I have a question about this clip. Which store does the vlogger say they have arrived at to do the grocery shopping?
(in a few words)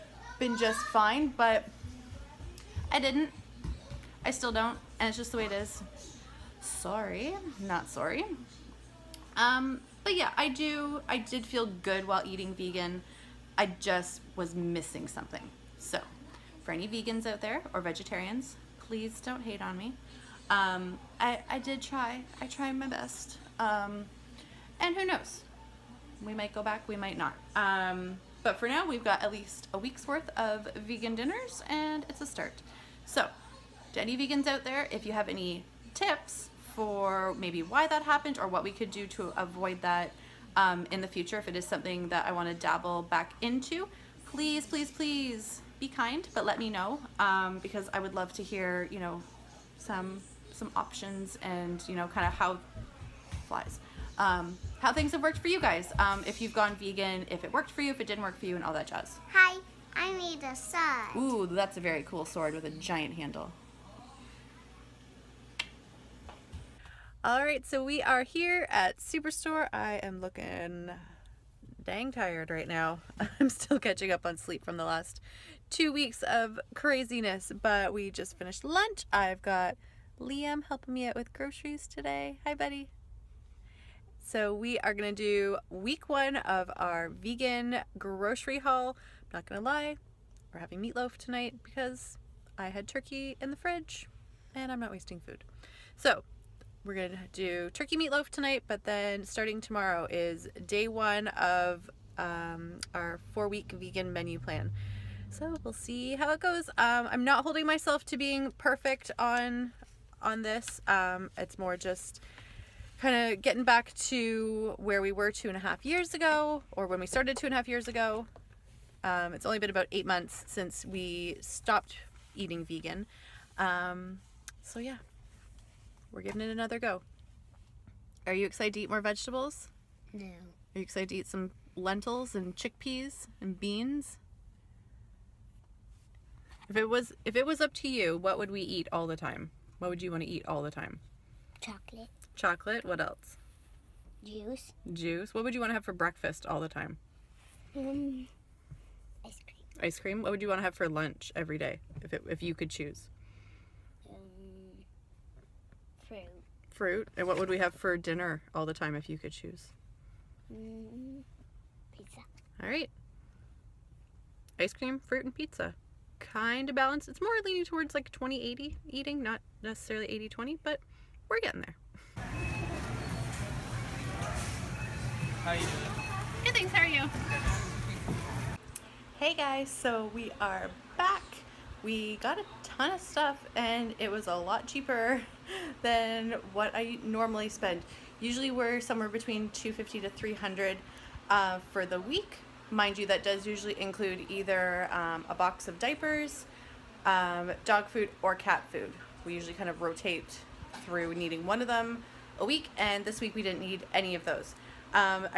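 Superstore.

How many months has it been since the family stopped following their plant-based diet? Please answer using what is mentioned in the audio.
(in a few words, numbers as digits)
8.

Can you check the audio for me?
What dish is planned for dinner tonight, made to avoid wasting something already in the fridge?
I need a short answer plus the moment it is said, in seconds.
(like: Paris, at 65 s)
Turkey meatloaf, at 97 s.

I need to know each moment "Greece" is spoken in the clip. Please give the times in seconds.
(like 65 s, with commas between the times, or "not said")
not said.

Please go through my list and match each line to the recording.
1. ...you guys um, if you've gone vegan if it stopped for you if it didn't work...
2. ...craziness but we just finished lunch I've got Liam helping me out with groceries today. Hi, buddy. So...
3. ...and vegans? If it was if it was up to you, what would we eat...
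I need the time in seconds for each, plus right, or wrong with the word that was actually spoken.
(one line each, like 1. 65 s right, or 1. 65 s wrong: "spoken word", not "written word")
1. 55 s wrong: "worked", not "stopped"
2. 76 s right
3. 133 s wrong: "beans", not "vegans".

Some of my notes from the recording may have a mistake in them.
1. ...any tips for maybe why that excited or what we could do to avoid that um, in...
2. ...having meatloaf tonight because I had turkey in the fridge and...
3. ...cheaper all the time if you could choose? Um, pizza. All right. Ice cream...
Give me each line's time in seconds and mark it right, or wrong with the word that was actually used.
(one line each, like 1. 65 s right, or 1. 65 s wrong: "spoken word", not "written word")
1. 35 s wrong: "happened", not "excited"
2. 90 s right
3. 157 s wrong: "dinner", not "cheaper".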